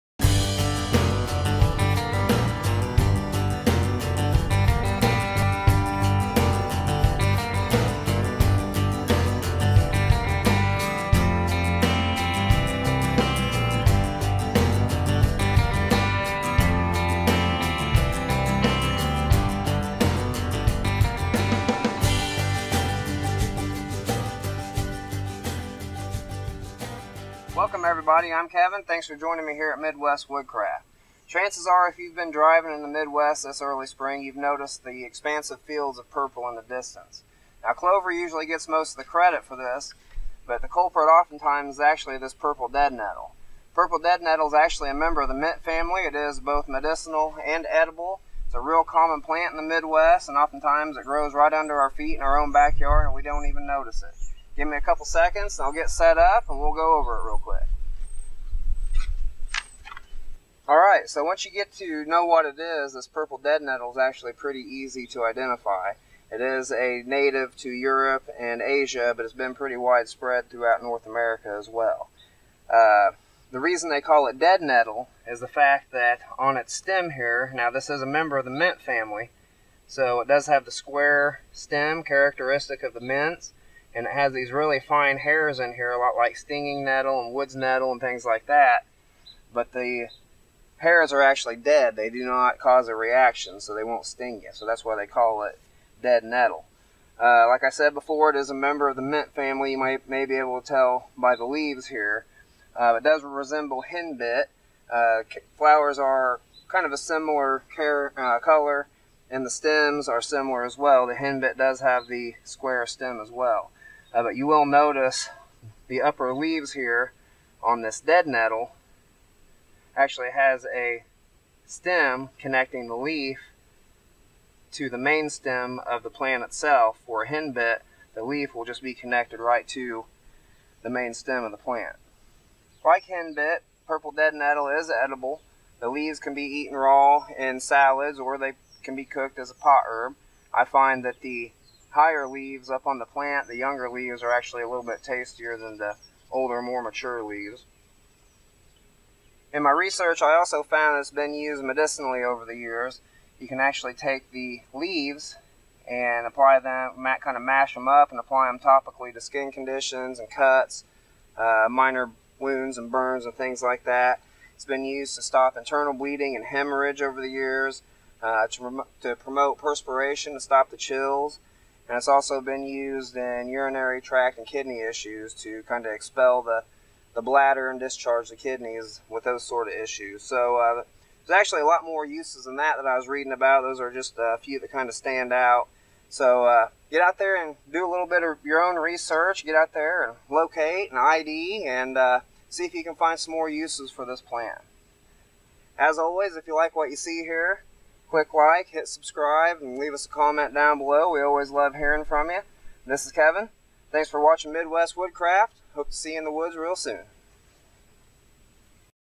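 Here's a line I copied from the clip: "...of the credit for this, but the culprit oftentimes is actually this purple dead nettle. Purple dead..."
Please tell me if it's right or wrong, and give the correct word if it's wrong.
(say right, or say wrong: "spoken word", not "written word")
right.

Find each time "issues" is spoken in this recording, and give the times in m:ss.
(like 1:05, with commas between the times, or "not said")
2:54, 2:59.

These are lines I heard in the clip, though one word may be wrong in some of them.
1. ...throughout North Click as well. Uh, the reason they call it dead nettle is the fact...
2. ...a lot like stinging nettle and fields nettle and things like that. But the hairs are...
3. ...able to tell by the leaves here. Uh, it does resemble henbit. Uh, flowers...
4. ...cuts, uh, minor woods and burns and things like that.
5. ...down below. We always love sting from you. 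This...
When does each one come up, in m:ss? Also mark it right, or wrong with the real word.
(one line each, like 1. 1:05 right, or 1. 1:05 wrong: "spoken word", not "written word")
1. 1:10 wrong: "America", not "Click"
2. 1:25 wrong: "woods", not "fields"
3. 1:40 right
4. 2:40 wrong: "wounds", not "woods"
5. 3:20 wrong: "hearing", not "sting".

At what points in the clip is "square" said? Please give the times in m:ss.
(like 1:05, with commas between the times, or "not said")
1:20, 1:52.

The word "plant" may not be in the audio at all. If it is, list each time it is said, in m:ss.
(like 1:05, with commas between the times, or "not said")
0:49, 2:06, 2:11, 2:23, 3:14.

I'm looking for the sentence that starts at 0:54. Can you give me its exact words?
Give me a couple seconds and I'll get set up and we'll go over it real quick.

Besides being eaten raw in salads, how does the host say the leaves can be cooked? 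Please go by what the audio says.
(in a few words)
as a pot herb.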